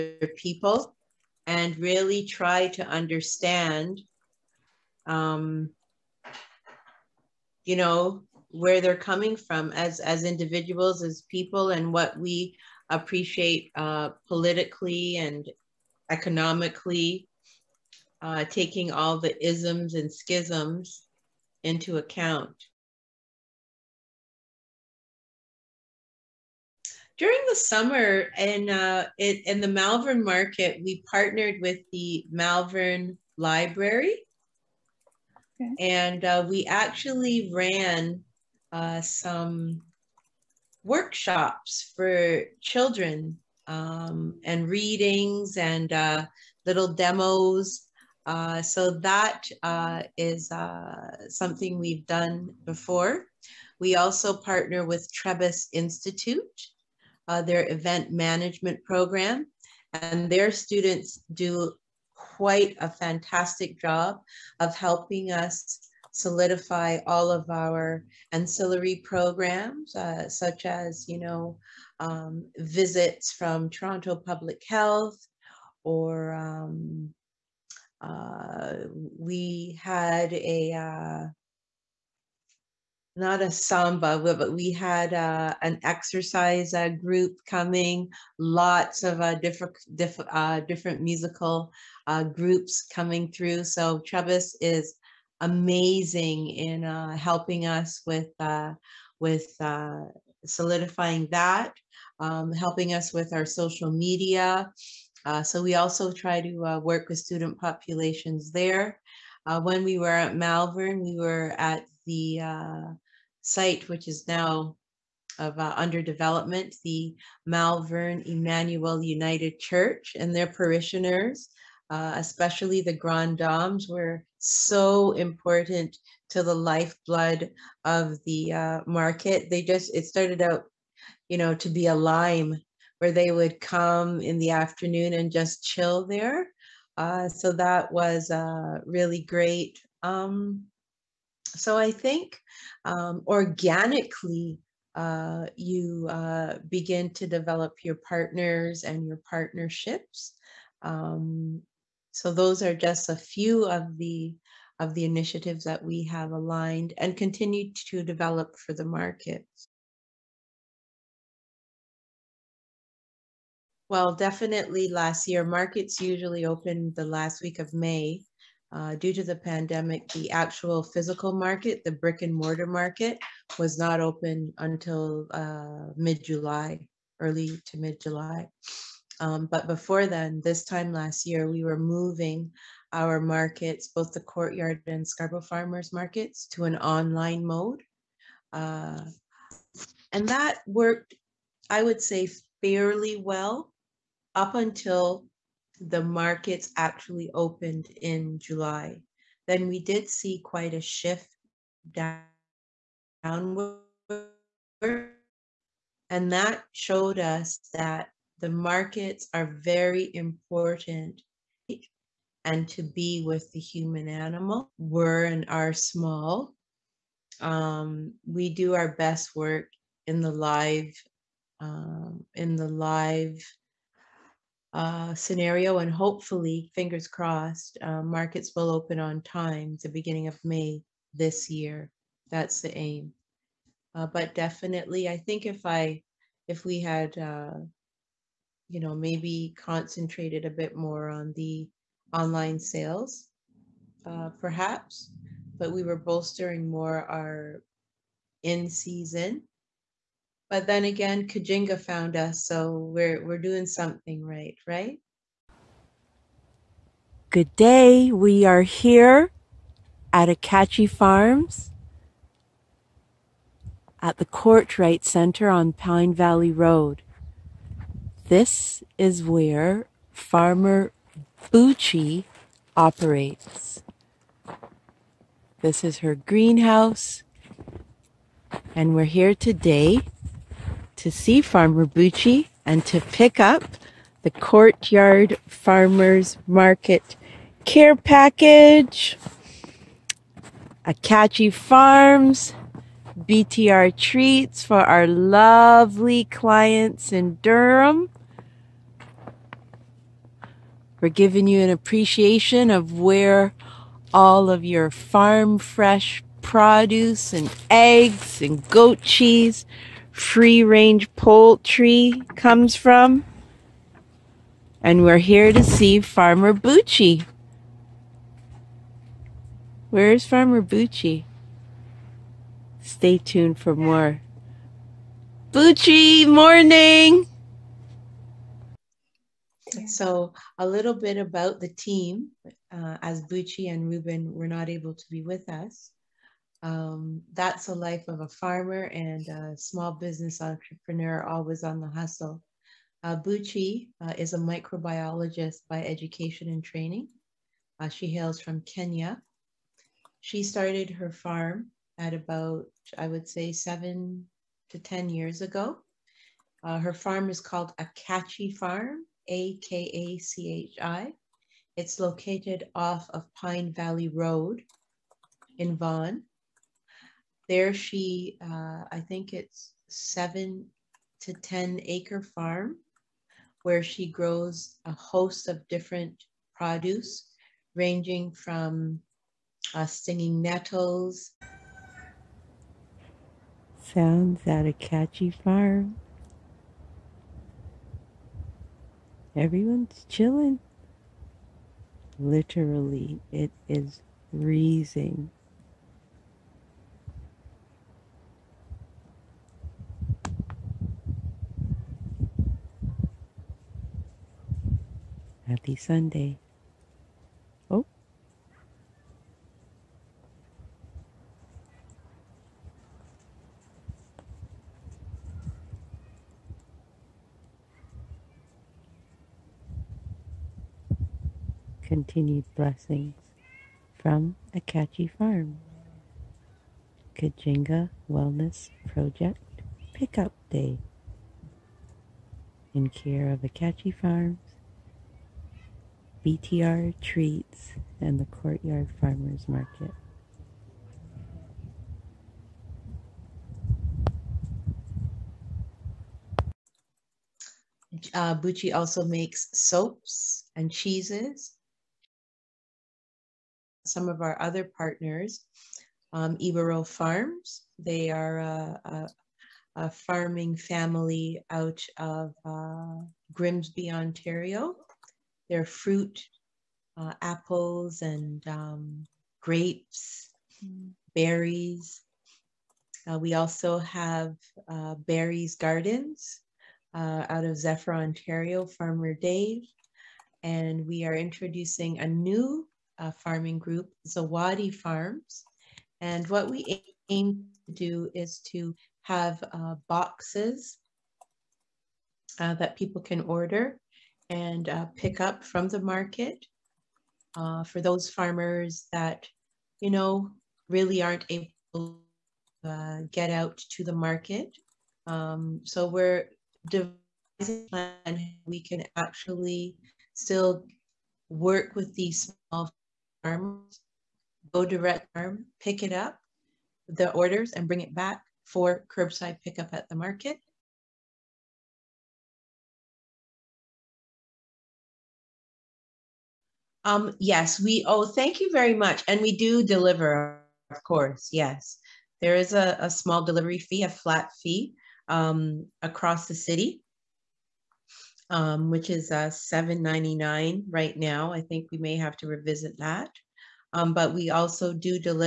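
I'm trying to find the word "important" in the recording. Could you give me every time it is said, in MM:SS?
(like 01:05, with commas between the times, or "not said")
02:05, 03:30.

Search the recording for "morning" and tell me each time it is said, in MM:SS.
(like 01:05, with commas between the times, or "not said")
05:26.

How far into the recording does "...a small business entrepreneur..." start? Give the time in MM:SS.
05:39.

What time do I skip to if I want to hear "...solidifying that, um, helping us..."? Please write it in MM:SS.
01:40.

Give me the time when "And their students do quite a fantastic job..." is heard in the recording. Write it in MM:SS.
01:00.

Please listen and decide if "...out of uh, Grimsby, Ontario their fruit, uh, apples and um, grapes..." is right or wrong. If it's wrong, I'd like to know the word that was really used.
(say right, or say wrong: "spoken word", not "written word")
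right.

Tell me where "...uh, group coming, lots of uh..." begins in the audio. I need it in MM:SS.
01:26.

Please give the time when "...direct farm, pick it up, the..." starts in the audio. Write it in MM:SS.
08:34.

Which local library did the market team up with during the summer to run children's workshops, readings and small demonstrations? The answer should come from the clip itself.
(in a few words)
Malvern Library.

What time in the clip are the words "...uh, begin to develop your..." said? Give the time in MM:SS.
02:26.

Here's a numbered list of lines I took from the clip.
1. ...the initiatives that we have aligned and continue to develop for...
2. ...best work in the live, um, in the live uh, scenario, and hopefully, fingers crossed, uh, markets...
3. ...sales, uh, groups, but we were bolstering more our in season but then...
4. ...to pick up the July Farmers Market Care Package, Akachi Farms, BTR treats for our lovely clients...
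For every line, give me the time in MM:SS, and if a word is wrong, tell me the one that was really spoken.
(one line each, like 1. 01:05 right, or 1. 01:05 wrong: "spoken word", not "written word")
1. 02:34 right
2. 03:38 right
3. 04:02 wrong: "perhaps", not "groups"
4. 04:42 wrong: "Courtyard", not "July".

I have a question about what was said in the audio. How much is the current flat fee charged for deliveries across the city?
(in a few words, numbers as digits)
$7.99.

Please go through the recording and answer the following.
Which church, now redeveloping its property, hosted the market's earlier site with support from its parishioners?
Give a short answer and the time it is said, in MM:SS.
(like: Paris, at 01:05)
Malvern Emmanuel United Church, at 01:57.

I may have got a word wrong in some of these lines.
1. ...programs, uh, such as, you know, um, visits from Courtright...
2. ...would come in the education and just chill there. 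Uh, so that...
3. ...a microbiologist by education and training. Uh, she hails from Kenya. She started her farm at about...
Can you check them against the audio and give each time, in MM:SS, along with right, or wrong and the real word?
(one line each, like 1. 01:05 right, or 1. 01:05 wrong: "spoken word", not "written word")
1. 01:08 wrong: "Toronto", not "Courtright"
2. 02:13 wrong: "afternoon", not "education"
3. 05:44 right.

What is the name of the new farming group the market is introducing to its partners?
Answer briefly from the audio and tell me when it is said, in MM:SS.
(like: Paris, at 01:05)
Zawadi Farms, at 08:04.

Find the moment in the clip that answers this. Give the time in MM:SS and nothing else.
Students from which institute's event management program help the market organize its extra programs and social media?
00:55.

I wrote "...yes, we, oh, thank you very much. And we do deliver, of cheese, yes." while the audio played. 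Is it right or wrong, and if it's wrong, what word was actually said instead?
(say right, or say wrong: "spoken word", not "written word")
wrong: "course", not "cheese".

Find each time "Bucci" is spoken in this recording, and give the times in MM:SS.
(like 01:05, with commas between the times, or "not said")
04:31, 04:41, 05:16, 05:20, 05:25, 05:33, 07:28.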